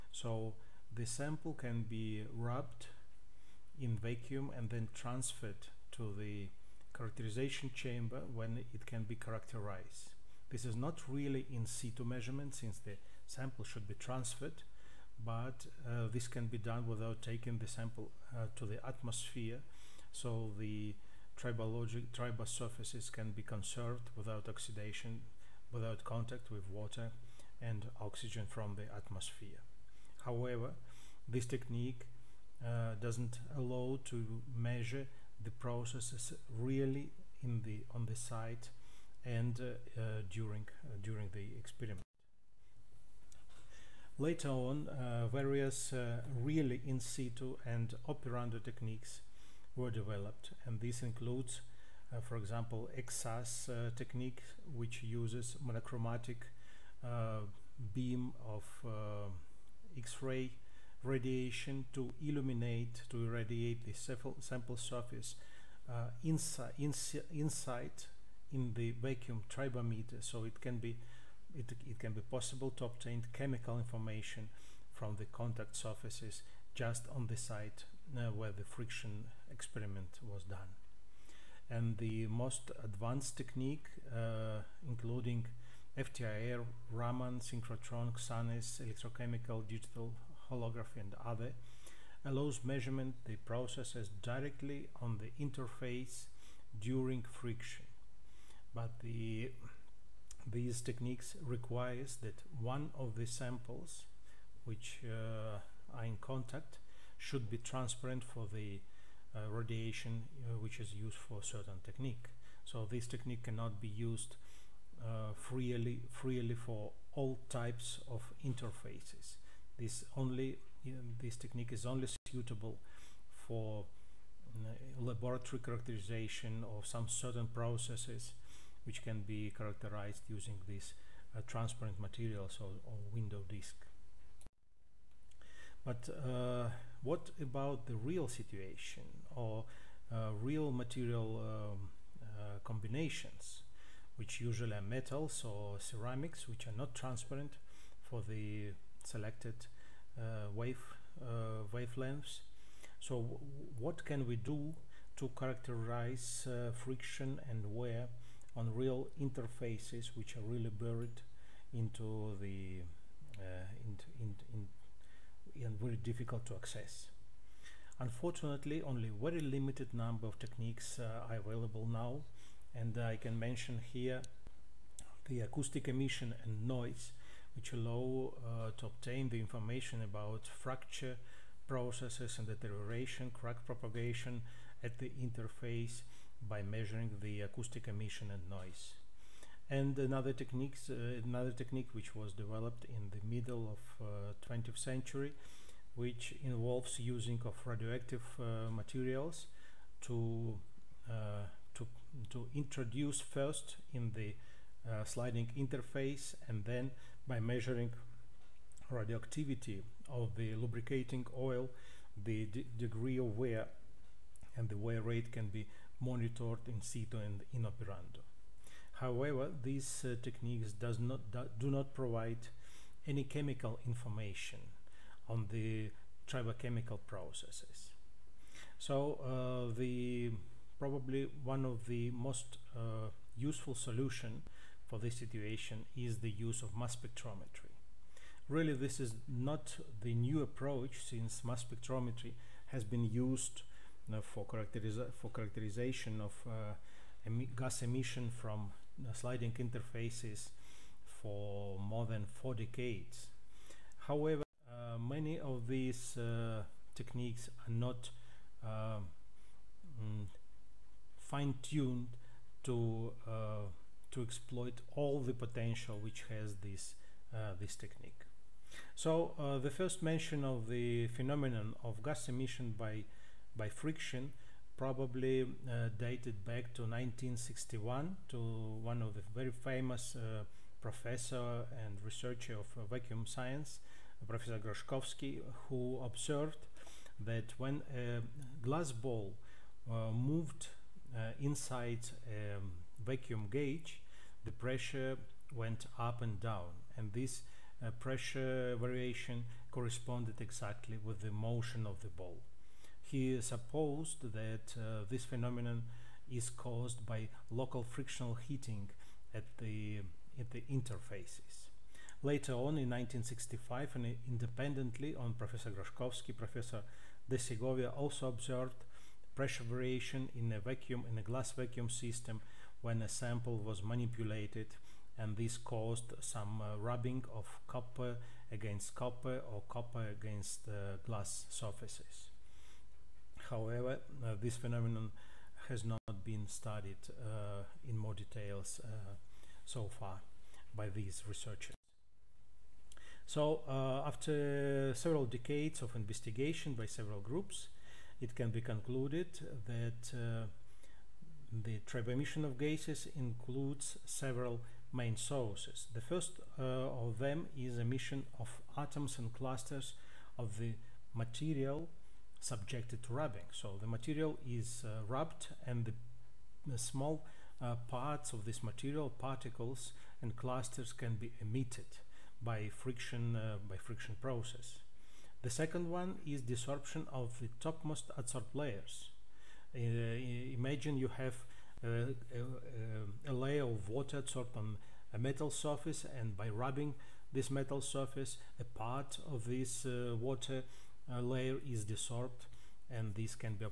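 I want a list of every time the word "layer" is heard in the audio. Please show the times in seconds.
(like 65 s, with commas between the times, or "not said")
378 s, 383 s, 391 s.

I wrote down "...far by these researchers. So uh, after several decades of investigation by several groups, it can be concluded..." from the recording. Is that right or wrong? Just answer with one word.
right.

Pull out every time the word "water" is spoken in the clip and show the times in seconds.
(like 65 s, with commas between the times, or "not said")
26 s, 383 s, 390 s.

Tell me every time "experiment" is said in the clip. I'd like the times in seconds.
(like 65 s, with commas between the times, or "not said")
41 s, 79 s.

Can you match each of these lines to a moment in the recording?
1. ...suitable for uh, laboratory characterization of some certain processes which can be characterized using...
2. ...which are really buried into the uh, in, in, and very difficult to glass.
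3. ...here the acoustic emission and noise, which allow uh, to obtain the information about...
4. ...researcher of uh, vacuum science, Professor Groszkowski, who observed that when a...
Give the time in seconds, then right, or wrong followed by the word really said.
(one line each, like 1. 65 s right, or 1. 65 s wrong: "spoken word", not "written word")
1. 122 s right
2. 160 s wrong: "access", not "glass"
3. 173 s right
4. 282 s right.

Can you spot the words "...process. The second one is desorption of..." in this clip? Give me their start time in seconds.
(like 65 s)
374 s.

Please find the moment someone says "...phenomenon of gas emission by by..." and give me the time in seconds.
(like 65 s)
271 s.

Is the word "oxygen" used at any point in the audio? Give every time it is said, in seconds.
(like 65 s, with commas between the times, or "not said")
27 s.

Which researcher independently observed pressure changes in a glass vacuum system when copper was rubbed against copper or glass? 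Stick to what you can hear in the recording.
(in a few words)
De Segovia.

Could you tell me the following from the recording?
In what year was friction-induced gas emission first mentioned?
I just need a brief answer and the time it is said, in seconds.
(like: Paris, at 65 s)
1961, at 276 s.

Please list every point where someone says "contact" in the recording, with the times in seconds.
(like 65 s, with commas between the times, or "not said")
26 s, 75 s, 106 s.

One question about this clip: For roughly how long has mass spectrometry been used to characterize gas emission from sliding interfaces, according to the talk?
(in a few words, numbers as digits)
More than four decades.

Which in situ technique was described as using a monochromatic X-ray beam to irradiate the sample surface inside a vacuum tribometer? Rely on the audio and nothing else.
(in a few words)
XSAS.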